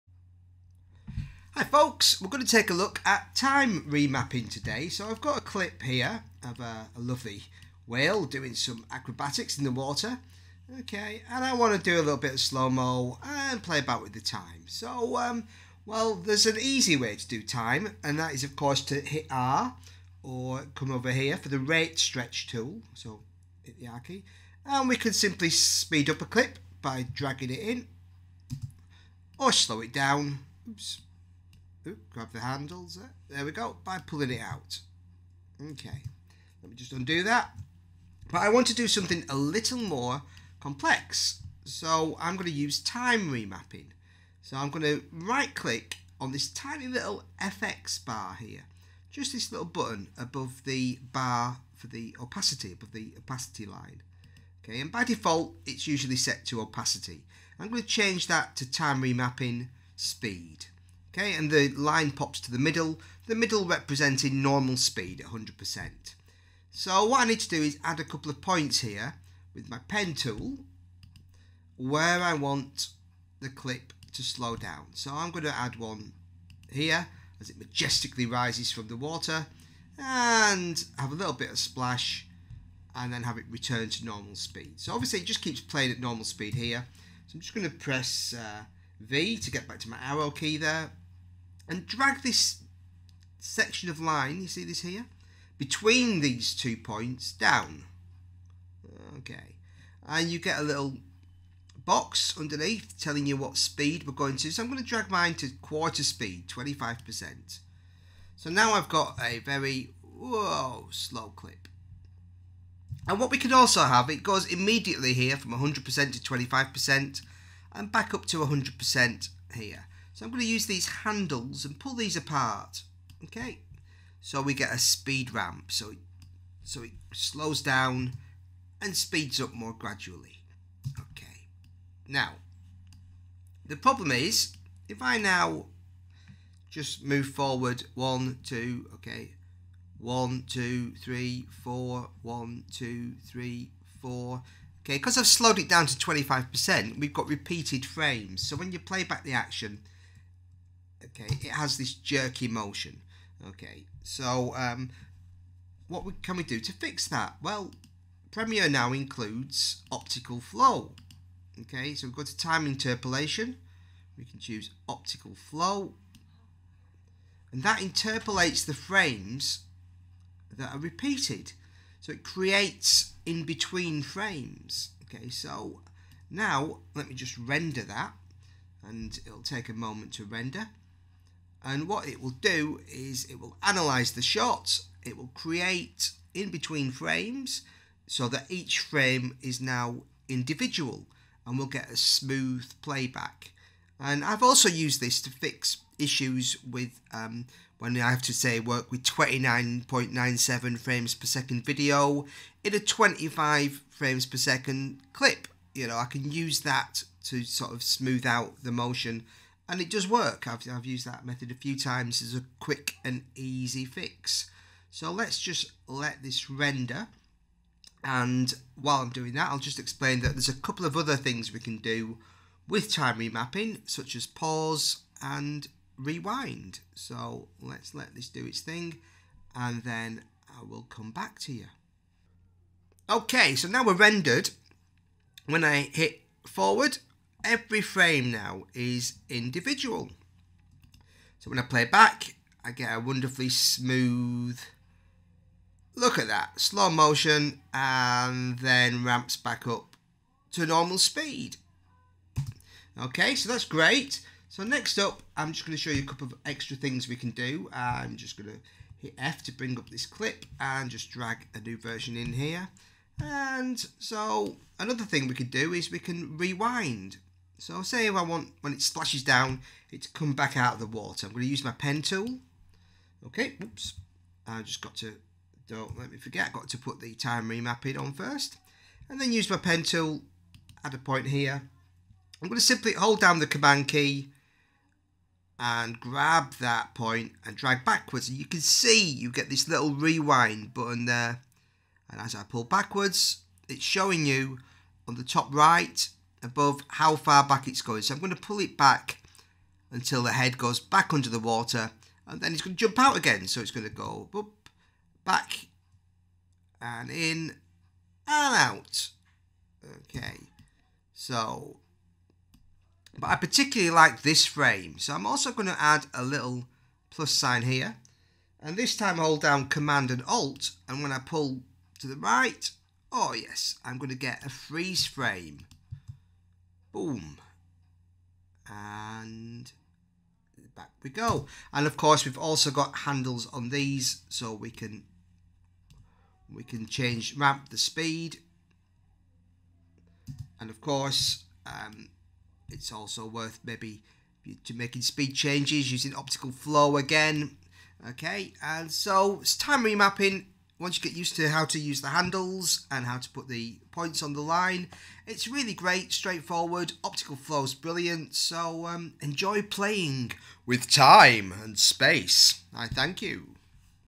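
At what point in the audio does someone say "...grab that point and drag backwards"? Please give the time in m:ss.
4:45.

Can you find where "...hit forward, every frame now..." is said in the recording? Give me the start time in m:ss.
3:55.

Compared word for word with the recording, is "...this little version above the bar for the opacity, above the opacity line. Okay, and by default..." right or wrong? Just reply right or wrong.
wrong.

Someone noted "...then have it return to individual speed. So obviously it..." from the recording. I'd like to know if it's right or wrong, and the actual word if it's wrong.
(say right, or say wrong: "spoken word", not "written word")
wrong: "normal", not "individual".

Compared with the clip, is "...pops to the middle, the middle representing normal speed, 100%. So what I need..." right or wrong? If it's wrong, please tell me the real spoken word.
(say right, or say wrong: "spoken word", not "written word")
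right.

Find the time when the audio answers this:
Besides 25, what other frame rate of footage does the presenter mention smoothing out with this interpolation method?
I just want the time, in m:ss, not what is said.
3:19.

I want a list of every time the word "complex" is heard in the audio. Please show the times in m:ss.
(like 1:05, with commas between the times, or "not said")
0:40.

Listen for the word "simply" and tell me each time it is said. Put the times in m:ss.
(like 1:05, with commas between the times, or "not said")
0:25, 4:42.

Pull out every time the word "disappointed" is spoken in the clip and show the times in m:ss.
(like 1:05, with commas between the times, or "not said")
not said.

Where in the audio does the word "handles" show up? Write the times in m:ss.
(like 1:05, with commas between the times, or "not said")
0:32, 2:00, 5:32, 5:52.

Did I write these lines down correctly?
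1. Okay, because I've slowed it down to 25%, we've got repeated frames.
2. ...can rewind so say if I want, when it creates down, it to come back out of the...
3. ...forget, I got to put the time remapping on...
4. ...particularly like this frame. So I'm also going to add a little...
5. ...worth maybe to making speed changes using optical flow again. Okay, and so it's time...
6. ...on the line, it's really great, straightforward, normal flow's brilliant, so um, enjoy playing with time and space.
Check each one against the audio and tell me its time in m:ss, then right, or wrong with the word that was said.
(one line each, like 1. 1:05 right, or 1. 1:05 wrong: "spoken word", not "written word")
1. 2:24 right
2. 4:25 wrong: "splashes", not "creates"
3. 4:36 right
4. 5:13 right
5. 5:43 right
6. 5:54 wrong: "optical", not "normal".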